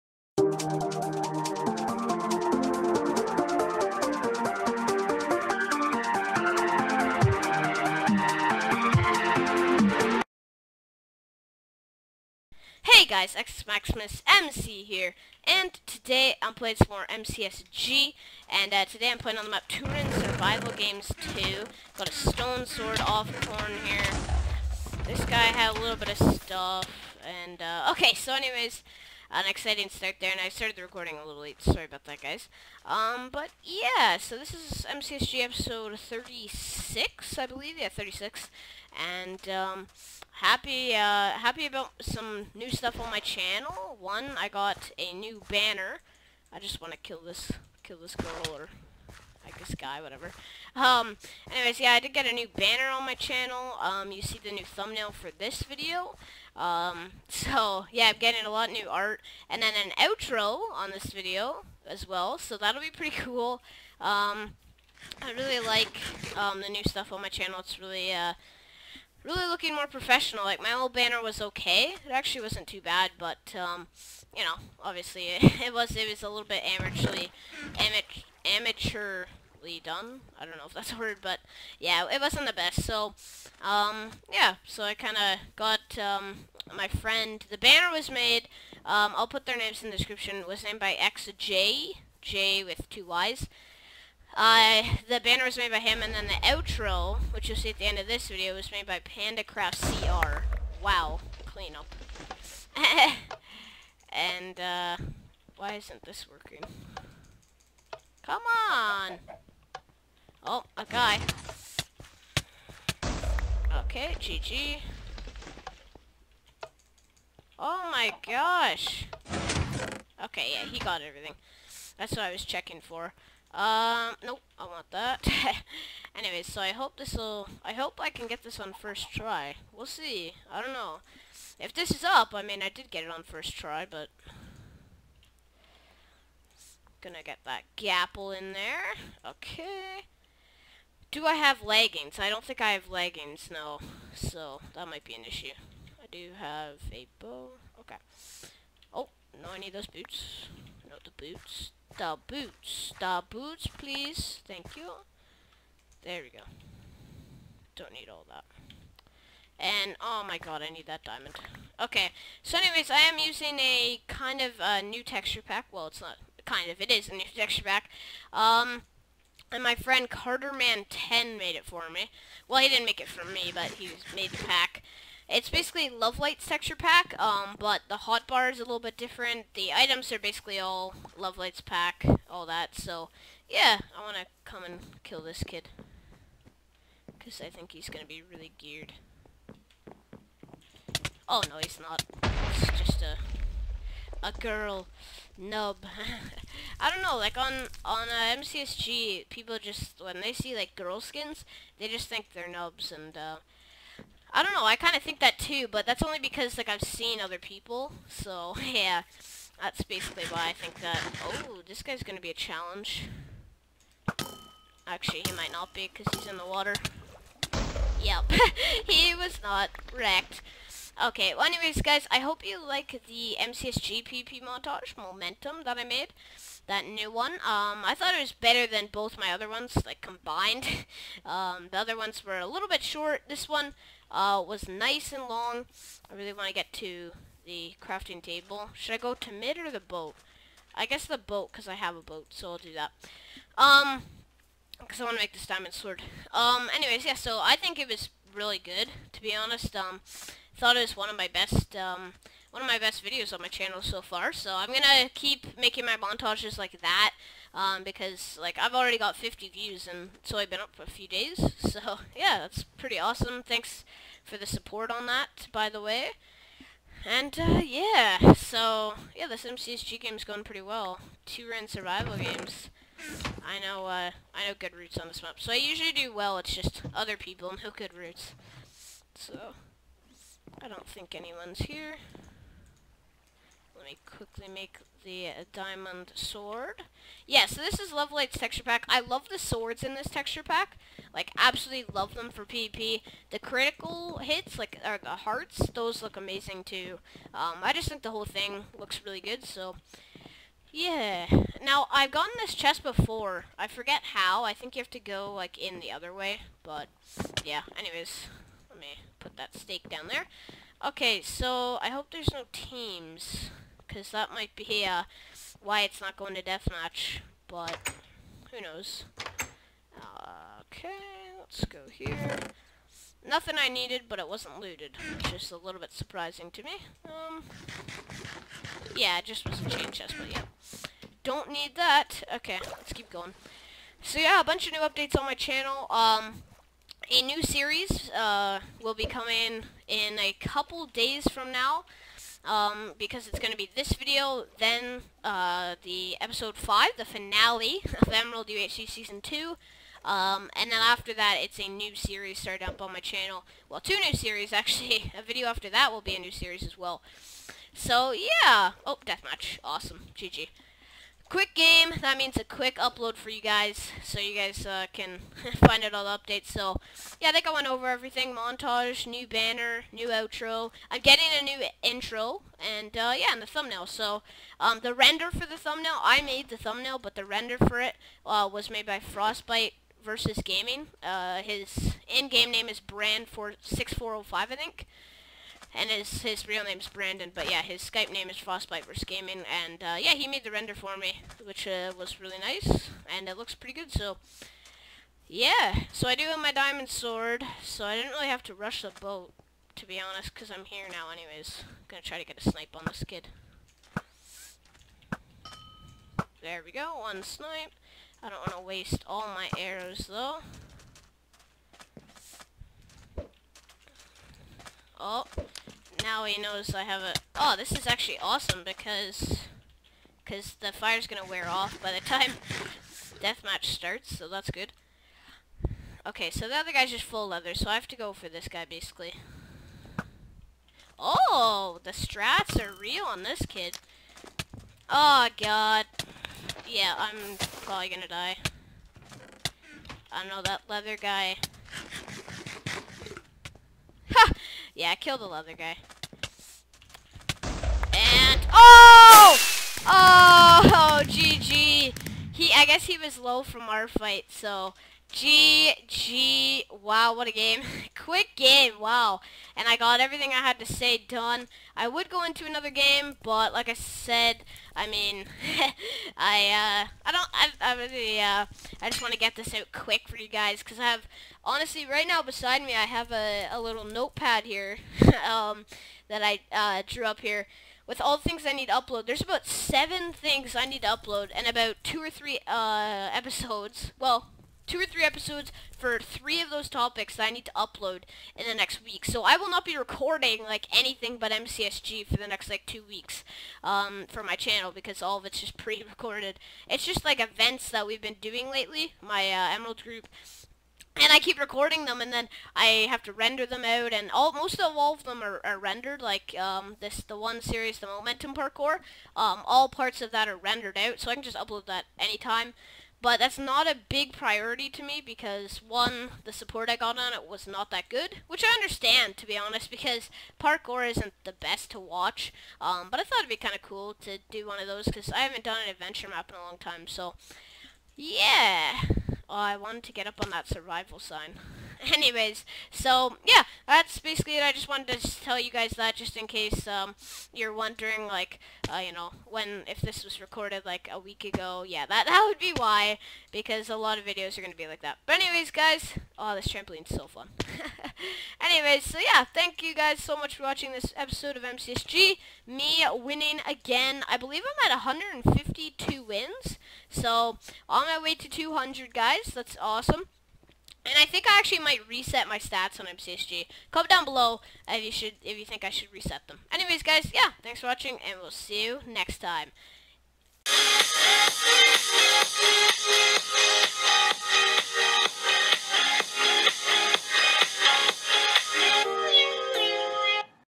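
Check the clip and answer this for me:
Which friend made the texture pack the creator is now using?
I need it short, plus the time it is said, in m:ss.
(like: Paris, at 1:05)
Carterman10, at 2:50.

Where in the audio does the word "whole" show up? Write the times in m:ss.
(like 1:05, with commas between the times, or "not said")
4:58.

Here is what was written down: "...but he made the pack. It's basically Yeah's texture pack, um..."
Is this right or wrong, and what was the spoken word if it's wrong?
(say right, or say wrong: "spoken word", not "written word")
wrong: "Lovelight", not "Yeah".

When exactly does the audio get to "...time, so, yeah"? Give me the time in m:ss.
8:46.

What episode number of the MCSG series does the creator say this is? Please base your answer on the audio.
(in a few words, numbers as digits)
36.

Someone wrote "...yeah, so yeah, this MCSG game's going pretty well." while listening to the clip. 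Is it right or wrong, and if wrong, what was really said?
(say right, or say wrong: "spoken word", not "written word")
right.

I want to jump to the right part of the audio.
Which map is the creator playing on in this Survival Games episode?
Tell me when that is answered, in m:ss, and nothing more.
0:19.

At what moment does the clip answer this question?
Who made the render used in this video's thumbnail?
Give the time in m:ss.
6:18.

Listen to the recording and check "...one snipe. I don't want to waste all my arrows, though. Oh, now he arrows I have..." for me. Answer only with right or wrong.
wrong.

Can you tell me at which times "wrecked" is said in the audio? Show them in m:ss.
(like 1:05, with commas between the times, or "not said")
3:39.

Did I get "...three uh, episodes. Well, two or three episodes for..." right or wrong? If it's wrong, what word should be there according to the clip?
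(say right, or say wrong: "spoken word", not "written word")
right.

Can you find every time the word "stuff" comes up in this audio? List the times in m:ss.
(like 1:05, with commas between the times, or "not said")
0:26, 0:42, 1:06.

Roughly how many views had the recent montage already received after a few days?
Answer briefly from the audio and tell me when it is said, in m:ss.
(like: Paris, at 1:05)
50, at 4:19.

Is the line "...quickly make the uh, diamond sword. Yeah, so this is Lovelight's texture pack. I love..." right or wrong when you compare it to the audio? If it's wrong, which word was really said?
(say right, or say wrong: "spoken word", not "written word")
right.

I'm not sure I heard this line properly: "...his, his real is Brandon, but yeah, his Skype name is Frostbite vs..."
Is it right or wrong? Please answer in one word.
right.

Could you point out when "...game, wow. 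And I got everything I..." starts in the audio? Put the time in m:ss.
7:38.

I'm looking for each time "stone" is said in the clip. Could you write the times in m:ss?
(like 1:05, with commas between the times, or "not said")
0:22.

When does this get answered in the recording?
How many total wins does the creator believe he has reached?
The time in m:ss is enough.
9:14.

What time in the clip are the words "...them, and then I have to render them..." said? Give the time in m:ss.
8:21.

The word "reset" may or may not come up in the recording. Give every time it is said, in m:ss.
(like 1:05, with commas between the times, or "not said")
9:21, 9:25.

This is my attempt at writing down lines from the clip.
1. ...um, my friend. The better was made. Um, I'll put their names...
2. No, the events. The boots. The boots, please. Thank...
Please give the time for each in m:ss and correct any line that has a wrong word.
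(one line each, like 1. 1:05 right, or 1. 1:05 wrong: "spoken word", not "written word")
1. 1:25 wrong: "banner", not "better"
2. 2:30 wrong: "boots", not "events".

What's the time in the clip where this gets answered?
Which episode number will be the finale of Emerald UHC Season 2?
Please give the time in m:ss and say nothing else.
5:46.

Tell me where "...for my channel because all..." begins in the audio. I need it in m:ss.
8:14.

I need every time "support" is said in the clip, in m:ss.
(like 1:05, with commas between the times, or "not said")
4:24, 8:36.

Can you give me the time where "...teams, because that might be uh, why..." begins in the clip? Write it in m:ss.
5:12.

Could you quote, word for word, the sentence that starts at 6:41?
I'm gonna try to get a snipe on this kid.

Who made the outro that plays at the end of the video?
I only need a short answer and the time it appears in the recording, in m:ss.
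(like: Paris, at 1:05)
PandaCraftCR, at 1:38.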